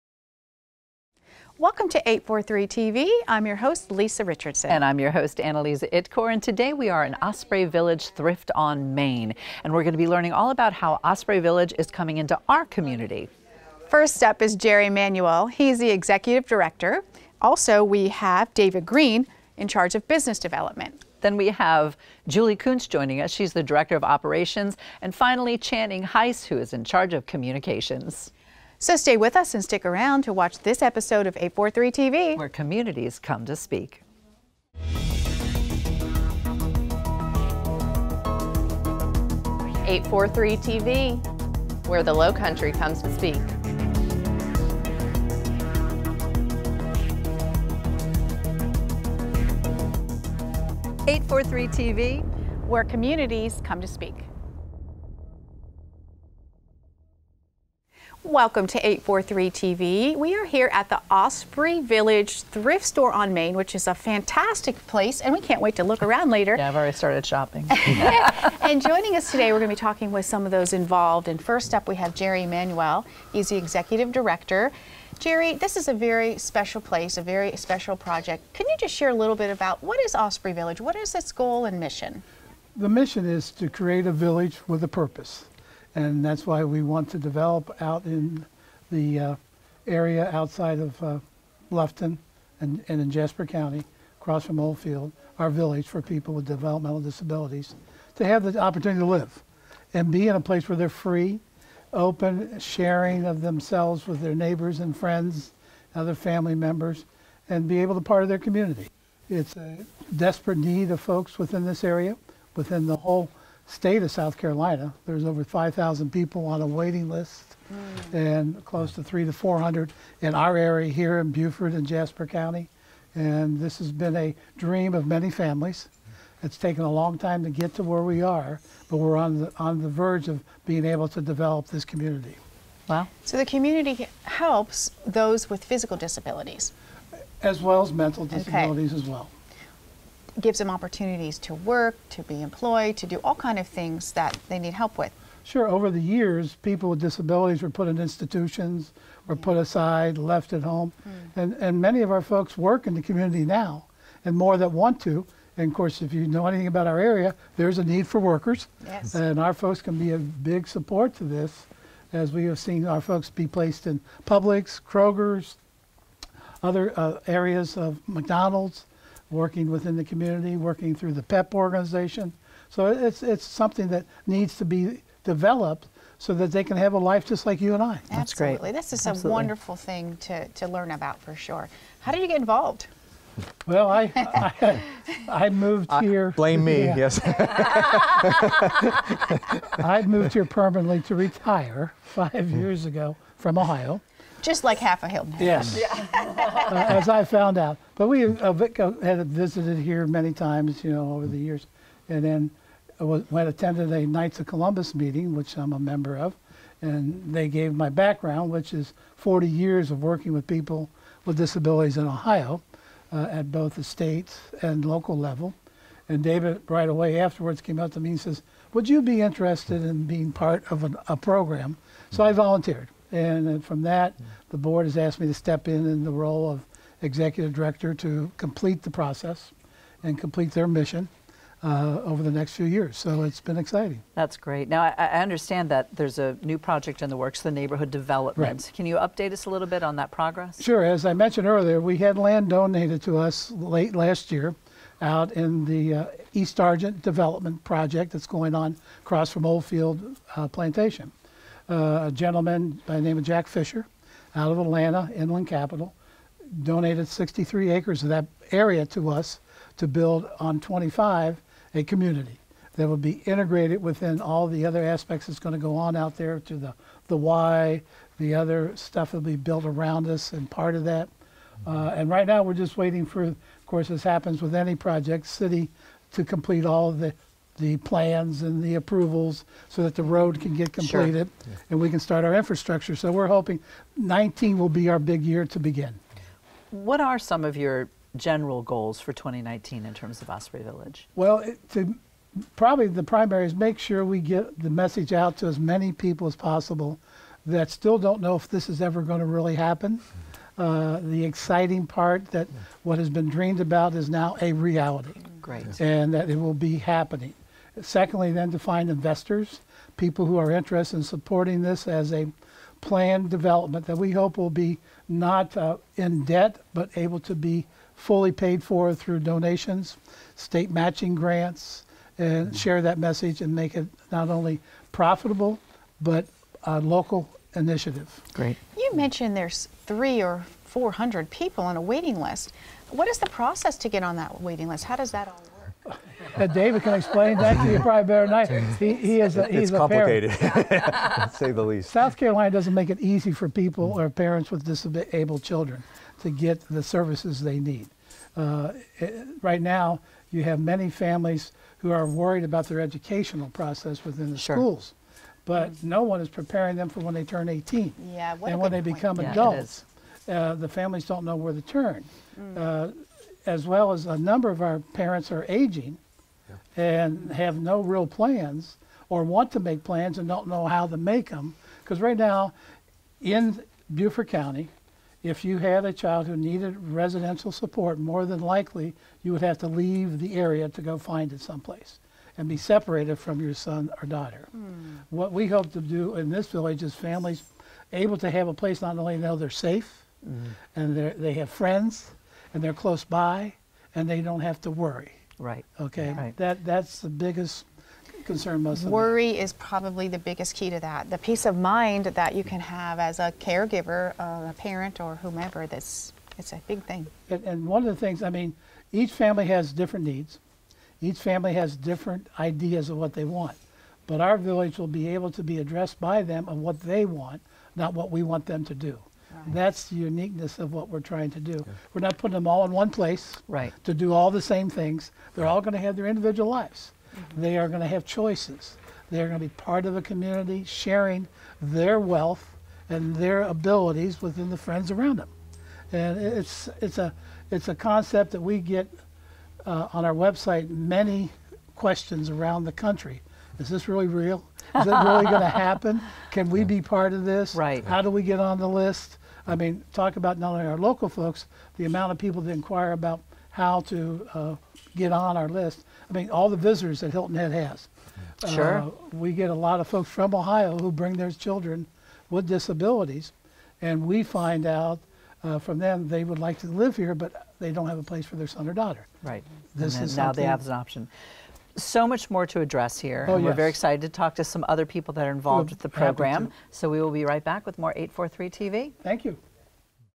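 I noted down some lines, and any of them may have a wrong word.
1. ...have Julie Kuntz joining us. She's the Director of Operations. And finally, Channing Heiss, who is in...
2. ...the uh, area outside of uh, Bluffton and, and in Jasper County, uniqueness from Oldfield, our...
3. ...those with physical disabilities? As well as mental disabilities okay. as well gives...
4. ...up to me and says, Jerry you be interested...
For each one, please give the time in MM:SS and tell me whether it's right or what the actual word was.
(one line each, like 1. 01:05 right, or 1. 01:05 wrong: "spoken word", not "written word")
1. 00:21 right
2. 01:28 wrong: "across", not "uniqueness"
3. 02:15 right
4. 03:37 wrong: "Would", not "Jerry".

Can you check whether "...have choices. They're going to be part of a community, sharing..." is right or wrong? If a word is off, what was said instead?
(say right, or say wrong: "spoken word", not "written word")
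right.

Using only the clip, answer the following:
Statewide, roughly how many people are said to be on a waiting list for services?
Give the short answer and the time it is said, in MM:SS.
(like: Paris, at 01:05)
over 5,000, at 01:55.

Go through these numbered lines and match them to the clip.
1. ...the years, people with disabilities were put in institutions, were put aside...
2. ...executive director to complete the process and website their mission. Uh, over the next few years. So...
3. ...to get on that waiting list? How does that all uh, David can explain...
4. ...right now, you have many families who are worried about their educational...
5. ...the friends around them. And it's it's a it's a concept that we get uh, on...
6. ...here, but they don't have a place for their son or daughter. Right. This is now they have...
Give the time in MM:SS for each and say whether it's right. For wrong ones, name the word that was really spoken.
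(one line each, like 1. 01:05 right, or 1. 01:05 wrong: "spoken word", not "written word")
1. 02:25 right
2. 03:47 wrong: "complete", not "website"
3. 05:33 right
4. 05:49 right
5. 07:14 right
6. 07:46 right.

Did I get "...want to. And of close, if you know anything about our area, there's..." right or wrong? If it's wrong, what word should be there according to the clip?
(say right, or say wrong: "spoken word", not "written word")
wrong: "course", not "close".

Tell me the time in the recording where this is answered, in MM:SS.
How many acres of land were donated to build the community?
04:17.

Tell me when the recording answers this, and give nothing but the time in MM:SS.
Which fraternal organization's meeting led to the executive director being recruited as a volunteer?
03:24.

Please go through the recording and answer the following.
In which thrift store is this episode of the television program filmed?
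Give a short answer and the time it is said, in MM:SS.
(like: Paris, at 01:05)
Osprey Village Thrift on Main, at 00:07.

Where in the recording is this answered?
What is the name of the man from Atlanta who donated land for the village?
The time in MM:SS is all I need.
04:13.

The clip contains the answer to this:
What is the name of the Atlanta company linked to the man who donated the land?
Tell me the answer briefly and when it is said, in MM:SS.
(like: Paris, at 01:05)
Inland Capital, at 04:15.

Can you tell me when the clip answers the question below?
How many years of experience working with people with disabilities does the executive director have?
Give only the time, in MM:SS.
03:29.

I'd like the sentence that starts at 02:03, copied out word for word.
And this has been a dream of many families.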